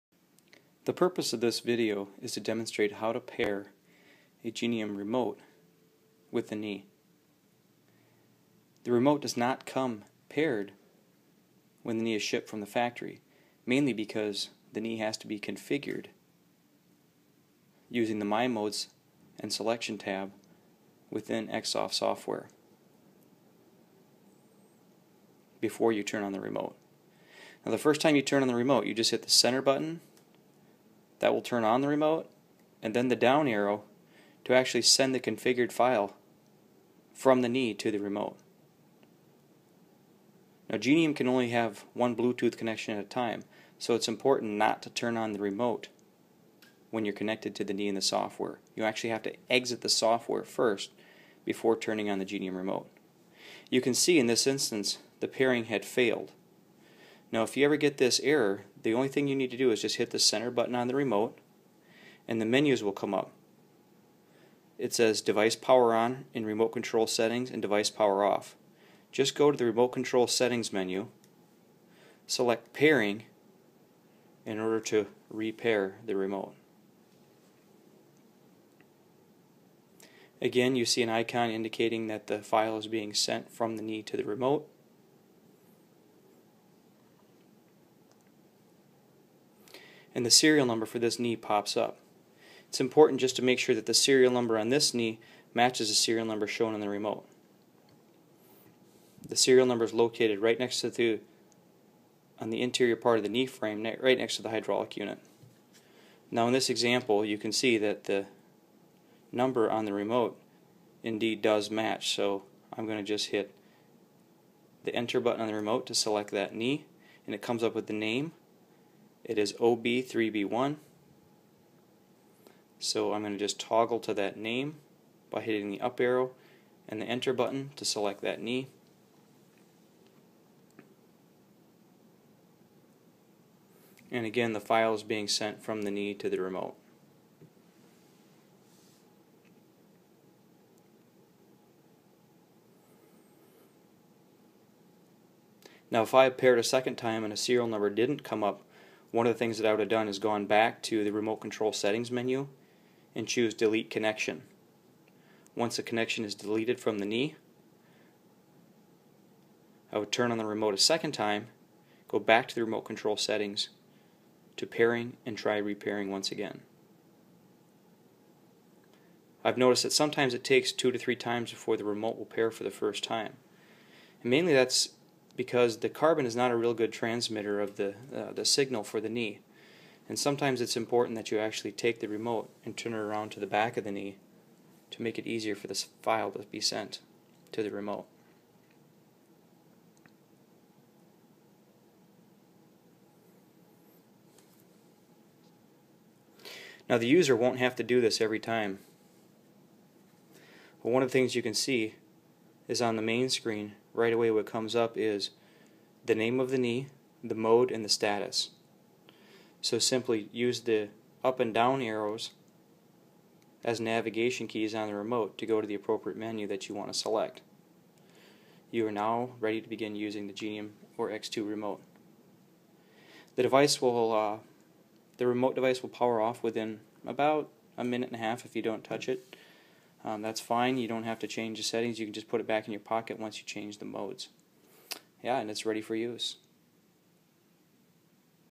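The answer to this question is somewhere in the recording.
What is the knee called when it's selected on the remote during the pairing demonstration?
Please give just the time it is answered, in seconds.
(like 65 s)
119 s.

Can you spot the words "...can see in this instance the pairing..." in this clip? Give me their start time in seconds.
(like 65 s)
53 s.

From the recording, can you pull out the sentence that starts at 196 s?
Now the user won't have to do this every time.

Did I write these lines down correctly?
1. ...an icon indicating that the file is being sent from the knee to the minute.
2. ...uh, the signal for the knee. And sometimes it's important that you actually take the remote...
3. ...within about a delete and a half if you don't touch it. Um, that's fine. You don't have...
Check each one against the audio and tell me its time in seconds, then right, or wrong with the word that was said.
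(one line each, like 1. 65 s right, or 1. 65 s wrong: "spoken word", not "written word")
1. 81 s wrong: "remote", not "minute"
2. 178 s right
3. 226 s wrong: "minute", not "delete".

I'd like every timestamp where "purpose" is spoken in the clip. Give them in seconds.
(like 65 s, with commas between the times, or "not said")
0 s.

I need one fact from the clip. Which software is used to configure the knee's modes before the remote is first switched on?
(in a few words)
Xsoft.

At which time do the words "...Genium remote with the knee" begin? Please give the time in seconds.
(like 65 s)
4 s.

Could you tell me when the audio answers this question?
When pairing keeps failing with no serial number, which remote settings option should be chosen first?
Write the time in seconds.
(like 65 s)
153 s.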